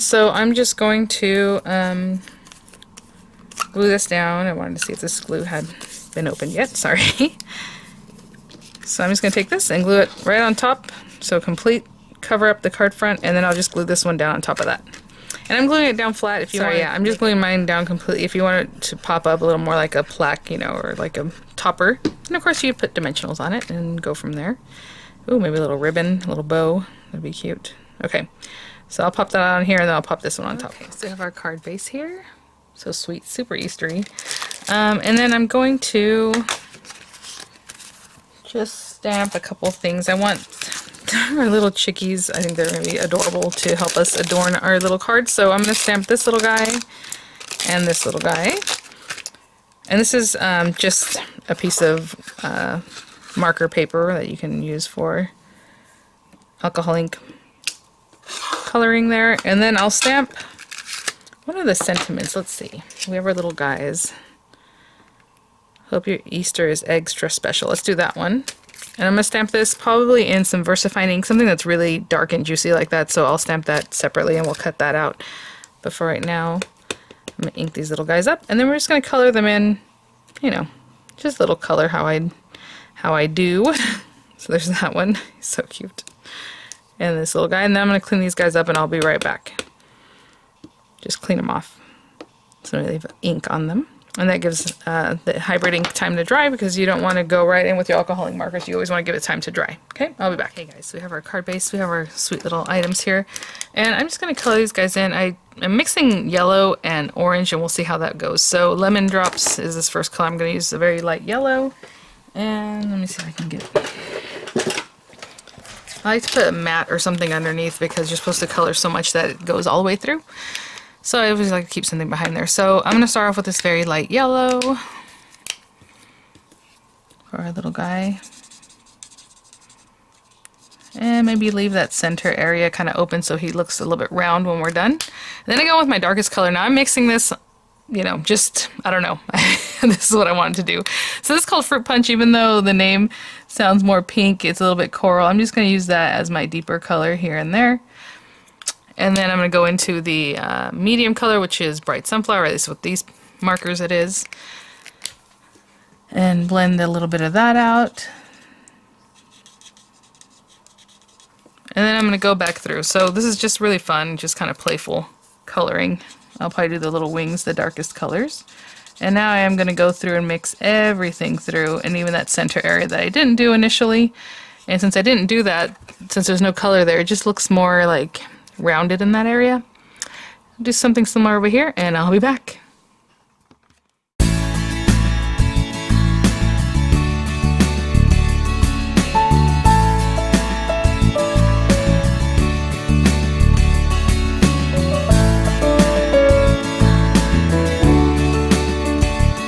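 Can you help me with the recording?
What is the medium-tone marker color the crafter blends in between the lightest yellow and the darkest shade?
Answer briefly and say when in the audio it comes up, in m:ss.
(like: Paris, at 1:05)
bright sunflower, at 2:31.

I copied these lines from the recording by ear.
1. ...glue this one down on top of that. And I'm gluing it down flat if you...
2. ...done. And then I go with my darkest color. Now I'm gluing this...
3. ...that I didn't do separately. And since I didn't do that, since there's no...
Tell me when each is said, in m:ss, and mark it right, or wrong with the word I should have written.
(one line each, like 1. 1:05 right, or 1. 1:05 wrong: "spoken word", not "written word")
1. 0:13 right
2. 2:14 wrong: "mixing", not "gluing"
3. 2:52 wrong: "initially", not "separately".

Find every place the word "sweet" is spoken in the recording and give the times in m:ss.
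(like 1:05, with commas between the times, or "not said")
0:32, 1:42.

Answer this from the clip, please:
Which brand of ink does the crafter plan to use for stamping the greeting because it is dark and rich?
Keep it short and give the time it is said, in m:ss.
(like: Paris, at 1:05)
Versafine, at 1:10.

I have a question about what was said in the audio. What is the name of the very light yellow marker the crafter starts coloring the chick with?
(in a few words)
Lemon Drops.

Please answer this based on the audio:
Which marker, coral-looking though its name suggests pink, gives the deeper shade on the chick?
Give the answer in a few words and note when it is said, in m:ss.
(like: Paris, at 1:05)
Fruit Punch, at 2:21.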